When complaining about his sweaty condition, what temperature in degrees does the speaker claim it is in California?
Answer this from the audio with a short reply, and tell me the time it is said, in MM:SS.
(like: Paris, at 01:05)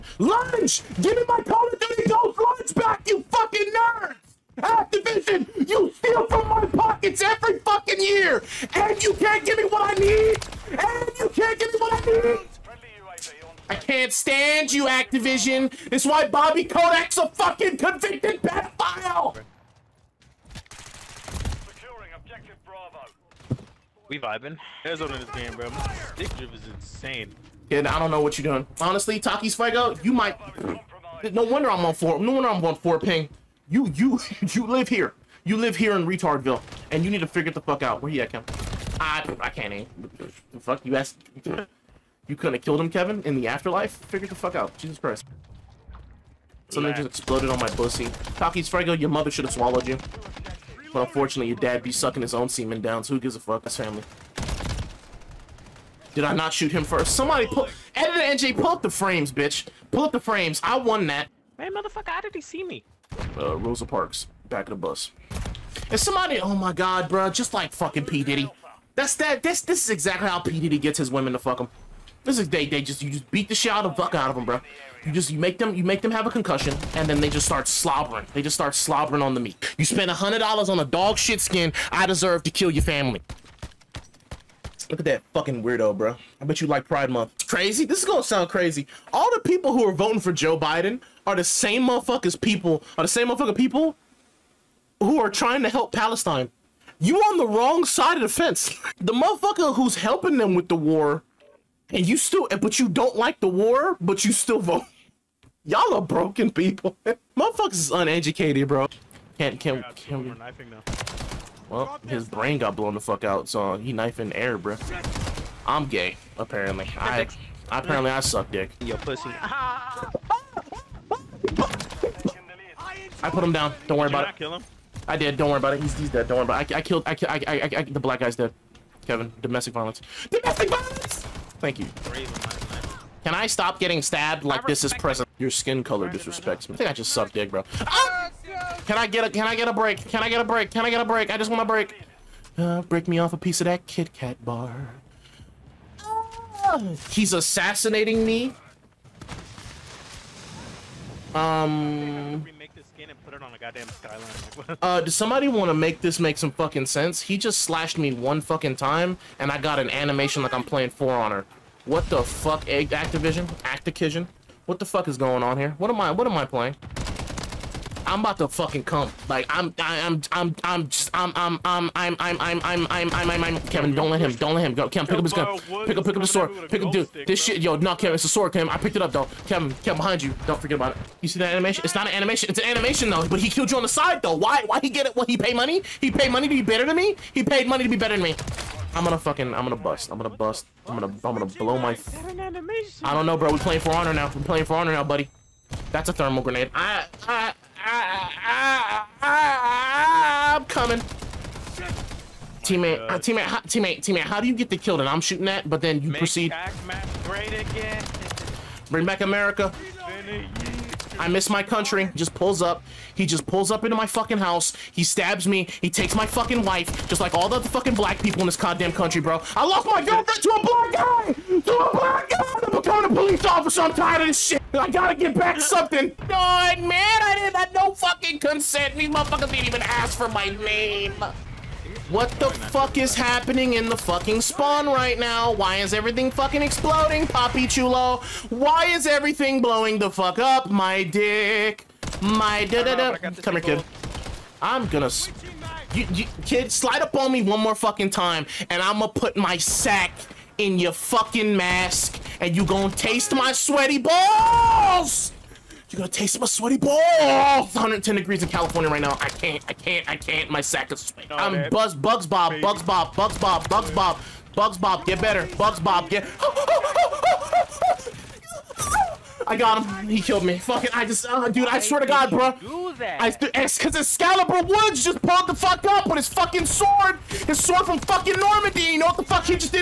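110, at 04:17.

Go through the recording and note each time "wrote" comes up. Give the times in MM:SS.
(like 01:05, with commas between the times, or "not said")
not said.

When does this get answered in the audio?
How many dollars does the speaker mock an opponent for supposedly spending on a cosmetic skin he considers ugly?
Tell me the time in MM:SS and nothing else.
01:20.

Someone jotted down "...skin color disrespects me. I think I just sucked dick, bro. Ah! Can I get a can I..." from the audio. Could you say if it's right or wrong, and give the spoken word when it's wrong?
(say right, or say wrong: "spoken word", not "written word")
right.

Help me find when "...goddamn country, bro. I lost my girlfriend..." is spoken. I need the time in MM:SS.
03:38.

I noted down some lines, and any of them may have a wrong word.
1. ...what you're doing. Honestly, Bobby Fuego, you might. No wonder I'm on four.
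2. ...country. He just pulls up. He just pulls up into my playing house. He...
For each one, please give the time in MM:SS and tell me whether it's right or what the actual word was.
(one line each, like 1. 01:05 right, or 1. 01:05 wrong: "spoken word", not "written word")
1. 00:28 wrong: "Taki", not "Bobby"
2. 03:31 wrong: "fucking", not "playing".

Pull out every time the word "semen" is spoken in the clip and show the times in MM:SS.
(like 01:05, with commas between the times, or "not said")
00:52.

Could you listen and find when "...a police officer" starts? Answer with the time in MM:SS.
03:43.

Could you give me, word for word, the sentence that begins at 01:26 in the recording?
I bet you like Pride Month.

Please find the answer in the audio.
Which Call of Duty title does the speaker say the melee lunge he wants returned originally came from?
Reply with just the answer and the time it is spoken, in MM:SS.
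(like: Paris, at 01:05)
Ghost, at 00:02.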